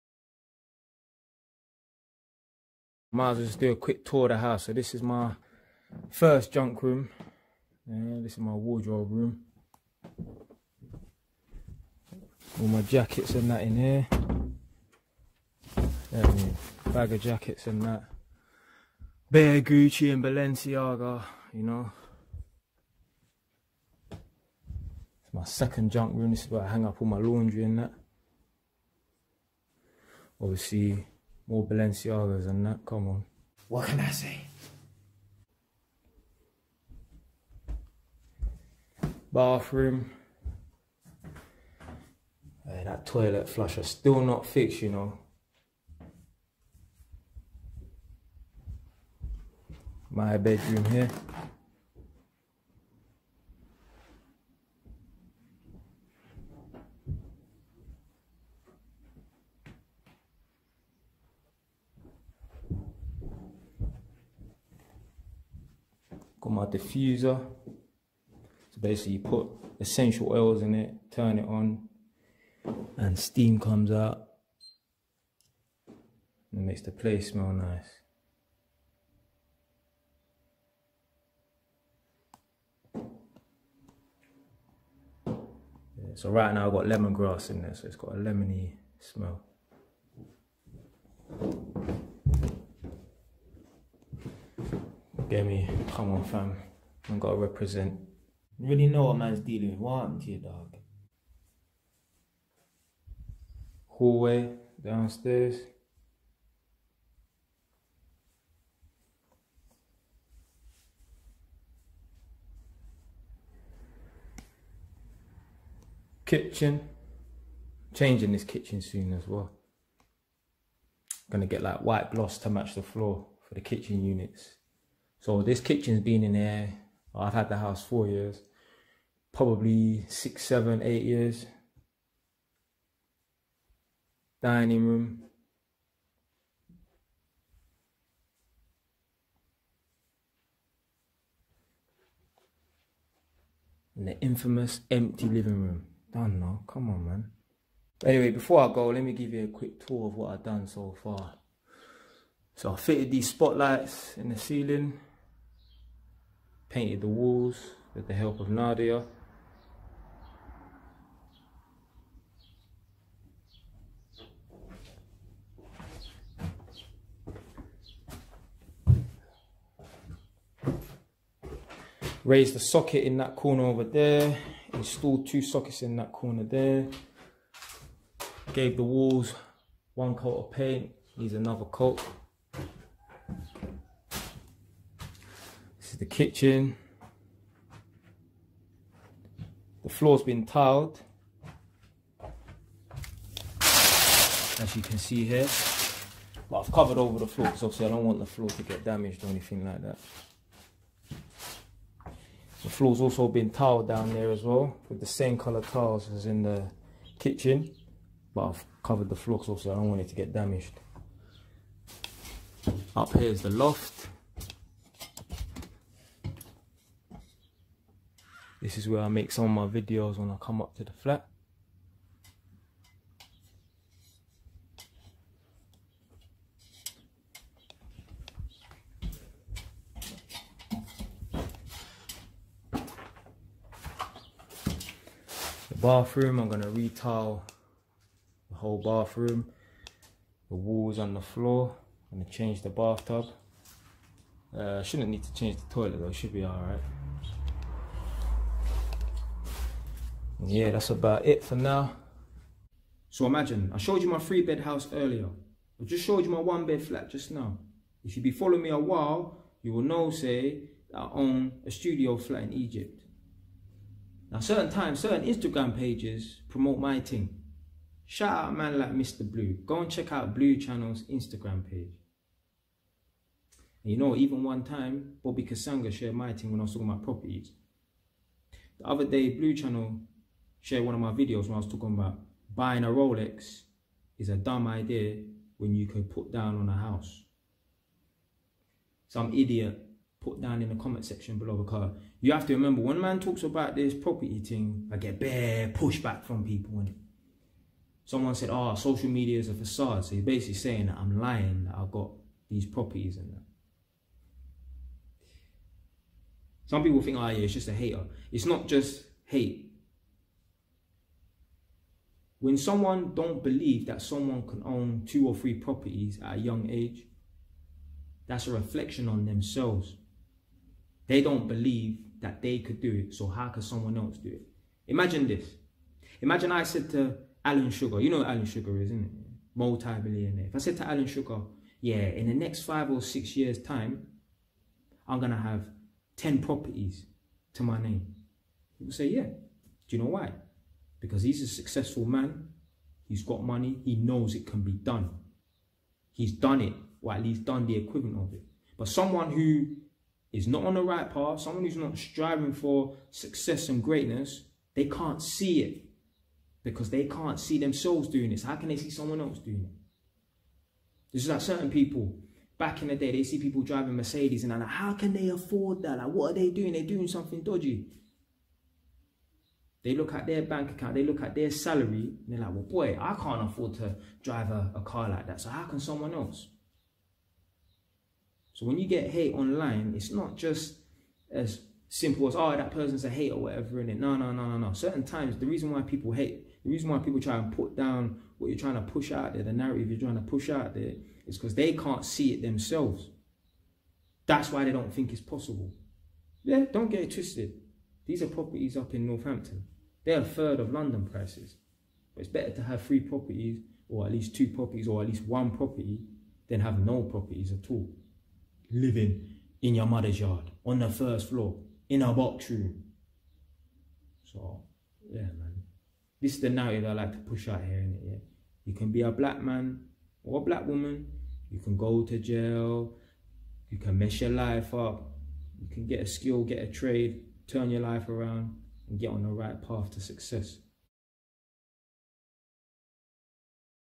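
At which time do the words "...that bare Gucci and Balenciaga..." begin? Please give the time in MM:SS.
00:17.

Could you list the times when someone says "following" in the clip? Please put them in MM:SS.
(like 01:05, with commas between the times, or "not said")
04:18.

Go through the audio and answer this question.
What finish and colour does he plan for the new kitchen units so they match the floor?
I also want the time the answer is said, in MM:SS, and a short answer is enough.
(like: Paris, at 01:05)
White gloss, at 02:01.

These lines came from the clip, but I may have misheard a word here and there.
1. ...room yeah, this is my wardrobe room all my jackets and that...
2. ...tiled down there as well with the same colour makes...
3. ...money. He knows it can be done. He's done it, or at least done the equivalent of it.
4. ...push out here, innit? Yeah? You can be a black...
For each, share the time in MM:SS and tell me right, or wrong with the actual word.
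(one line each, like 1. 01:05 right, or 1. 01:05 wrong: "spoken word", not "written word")
1. 00:06 right
2. 03:23 wrong: "tiles", not "makes"
3. 05:43 right
4. 06:57 right.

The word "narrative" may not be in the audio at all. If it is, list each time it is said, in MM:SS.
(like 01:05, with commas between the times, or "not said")
06:29, 06:56.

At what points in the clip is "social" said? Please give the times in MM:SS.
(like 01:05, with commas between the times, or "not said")
04:58.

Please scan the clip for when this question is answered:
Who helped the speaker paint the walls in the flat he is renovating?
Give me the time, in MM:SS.
02:38.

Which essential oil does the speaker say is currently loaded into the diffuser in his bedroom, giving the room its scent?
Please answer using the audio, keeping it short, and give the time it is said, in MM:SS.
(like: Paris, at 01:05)
Lemongrass, at 01:26.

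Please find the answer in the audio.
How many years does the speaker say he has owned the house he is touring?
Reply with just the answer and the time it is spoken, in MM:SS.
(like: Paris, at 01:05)
4, at 02:07.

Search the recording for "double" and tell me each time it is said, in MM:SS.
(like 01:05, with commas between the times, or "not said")
not said.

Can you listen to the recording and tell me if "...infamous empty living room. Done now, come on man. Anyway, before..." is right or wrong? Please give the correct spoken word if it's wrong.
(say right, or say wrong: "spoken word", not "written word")
right.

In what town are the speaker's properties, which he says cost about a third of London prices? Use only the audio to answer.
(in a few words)
Northampton.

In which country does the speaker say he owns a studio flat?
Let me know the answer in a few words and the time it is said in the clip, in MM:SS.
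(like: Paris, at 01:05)
Egypt, at 04:22.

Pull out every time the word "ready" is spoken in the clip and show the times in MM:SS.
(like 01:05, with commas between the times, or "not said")
not said.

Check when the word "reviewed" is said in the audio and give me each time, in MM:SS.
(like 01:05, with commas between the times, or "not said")
not said.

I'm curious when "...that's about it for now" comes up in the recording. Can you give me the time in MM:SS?
04:10.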